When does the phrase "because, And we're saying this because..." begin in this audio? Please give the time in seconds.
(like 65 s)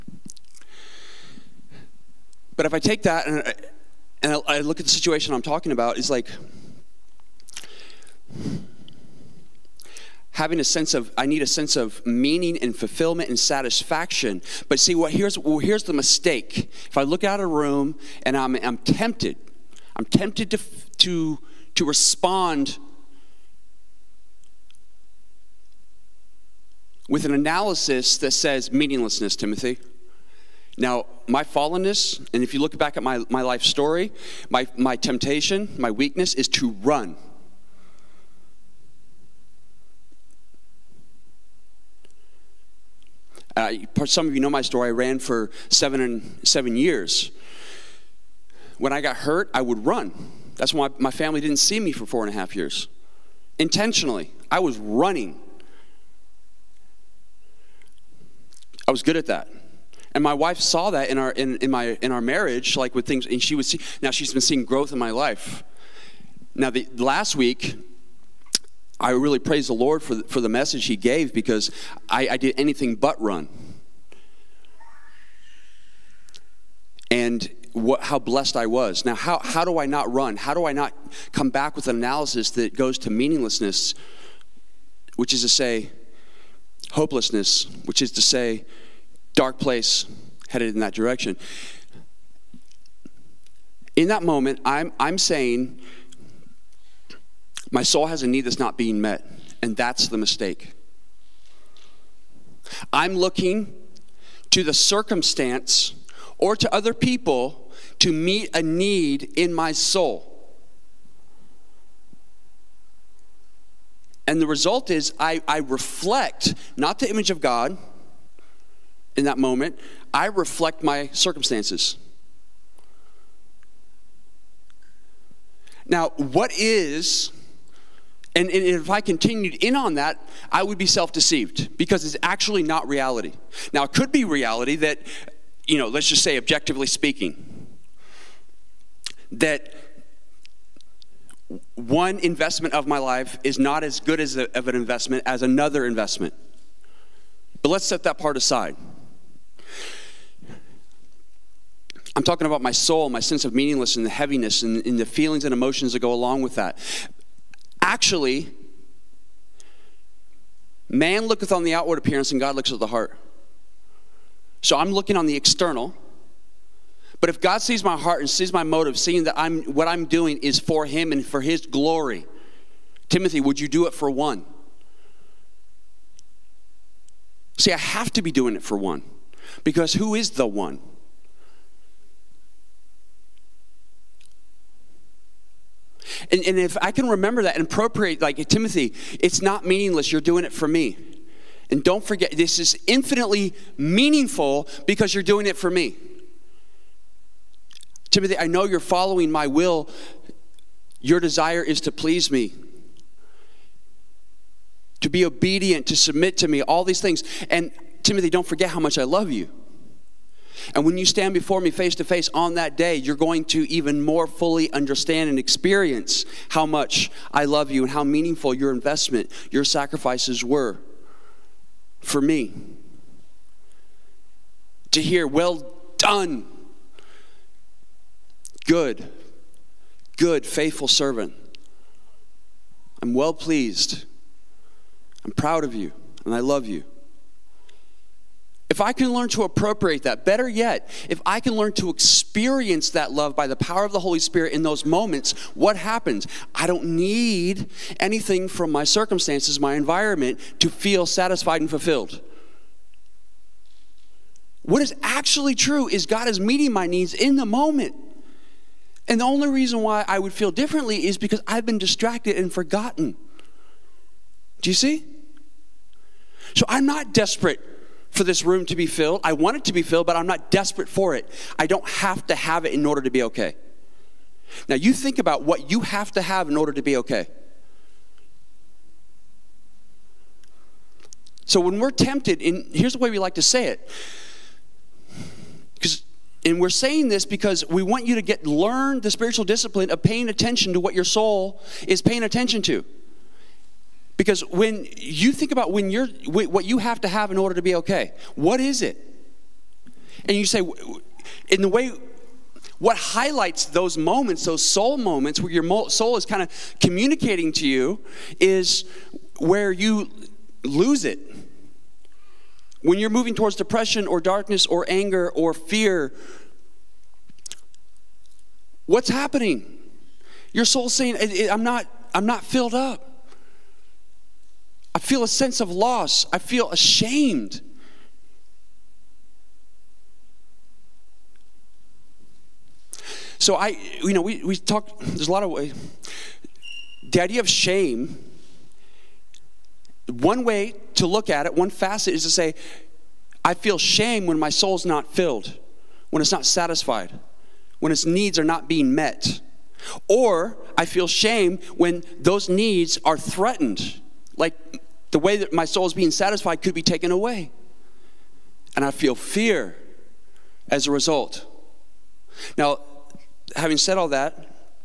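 285 s.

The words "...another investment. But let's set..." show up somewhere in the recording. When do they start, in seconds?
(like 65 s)
145 s.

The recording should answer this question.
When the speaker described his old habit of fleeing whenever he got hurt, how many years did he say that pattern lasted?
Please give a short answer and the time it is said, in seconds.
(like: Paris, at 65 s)
7, at 46 s.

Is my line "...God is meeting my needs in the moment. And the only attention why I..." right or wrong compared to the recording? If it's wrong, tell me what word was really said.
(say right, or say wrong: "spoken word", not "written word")
wrong: "reason", not "attention".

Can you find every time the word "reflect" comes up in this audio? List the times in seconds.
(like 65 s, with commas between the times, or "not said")
115 s, 120 s.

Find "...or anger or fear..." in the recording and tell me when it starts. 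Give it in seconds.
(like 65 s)
314 s.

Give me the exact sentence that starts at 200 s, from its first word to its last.
Your desire is to please me, to be obedient, to submit to me, all these things.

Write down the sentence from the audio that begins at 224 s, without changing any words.
To hear, well done, good, good, faithful servant.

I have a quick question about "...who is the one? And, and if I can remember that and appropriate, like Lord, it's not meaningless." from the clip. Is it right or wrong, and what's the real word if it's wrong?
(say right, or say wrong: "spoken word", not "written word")
wrong: "Timothy", not "Lord".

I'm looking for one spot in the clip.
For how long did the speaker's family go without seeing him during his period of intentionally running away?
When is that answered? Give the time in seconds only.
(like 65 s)
52 s.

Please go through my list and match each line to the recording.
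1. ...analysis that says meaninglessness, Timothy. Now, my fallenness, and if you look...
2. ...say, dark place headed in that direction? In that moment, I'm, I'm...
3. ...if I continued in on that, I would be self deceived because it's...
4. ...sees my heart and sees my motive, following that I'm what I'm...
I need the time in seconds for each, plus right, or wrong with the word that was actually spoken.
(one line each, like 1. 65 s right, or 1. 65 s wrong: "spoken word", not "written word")
1. 27 s right
2. 88 s right
3. 128 s right
4. 167 s wrong: "seeing", not "following".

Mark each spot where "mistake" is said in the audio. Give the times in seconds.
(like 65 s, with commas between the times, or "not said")
15 s, 100 s.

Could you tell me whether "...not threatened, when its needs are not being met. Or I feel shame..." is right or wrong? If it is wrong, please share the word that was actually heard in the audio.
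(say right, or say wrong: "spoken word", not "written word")
wrong: "satisfied", not "threatened".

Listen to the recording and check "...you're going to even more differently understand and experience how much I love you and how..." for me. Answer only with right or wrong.
wrong.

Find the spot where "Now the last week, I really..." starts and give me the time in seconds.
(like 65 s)
66 s.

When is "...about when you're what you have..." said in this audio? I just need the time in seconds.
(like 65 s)
295 s.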